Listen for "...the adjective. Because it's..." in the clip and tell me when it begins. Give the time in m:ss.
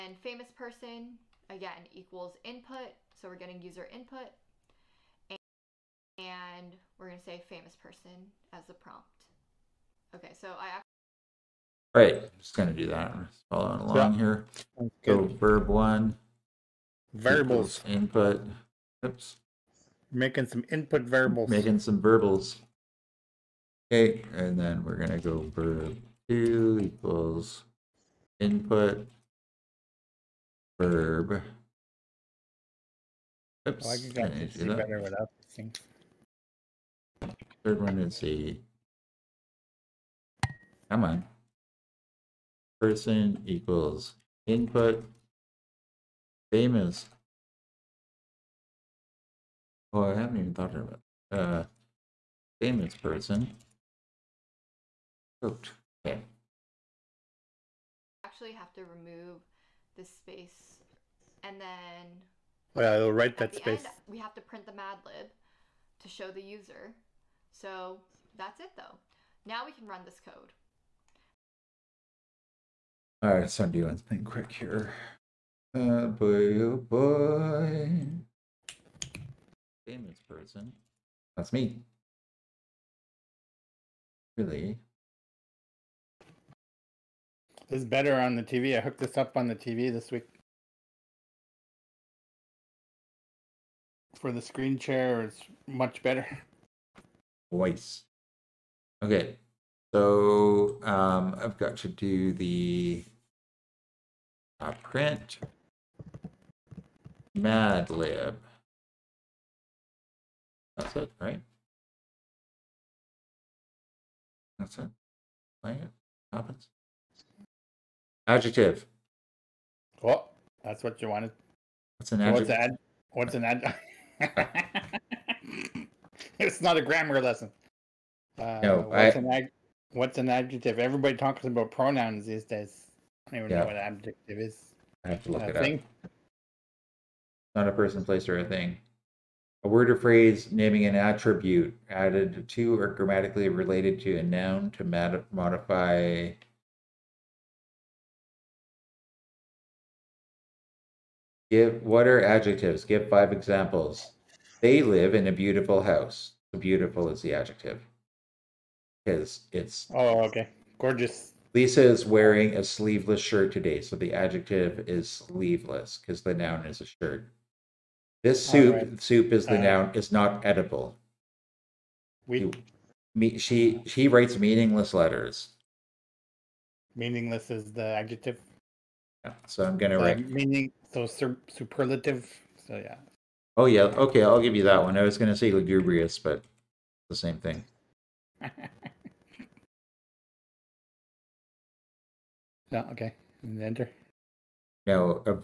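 2:37.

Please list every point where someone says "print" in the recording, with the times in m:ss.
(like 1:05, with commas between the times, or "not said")
1:04, 1:44.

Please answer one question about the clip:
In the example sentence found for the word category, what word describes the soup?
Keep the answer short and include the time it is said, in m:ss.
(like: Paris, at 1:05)
edible, at 2:50.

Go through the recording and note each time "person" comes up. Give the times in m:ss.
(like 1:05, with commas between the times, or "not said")
0:00, 0:07, 0:42, 0:52, 1:20, 2:17.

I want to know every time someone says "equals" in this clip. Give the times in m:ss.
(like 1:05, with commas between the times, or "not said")
0:01, 0:26, 0:43.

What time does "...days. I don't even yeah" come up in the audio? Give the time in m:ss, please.
2:12.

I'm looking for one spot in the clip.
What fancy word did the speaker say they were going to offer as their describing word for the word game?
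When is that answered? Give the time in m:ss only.
3:05.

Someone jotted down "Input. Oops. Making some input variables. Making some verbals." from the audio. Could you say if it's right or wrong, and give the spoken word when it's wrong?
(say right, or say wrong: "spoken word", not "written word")
right.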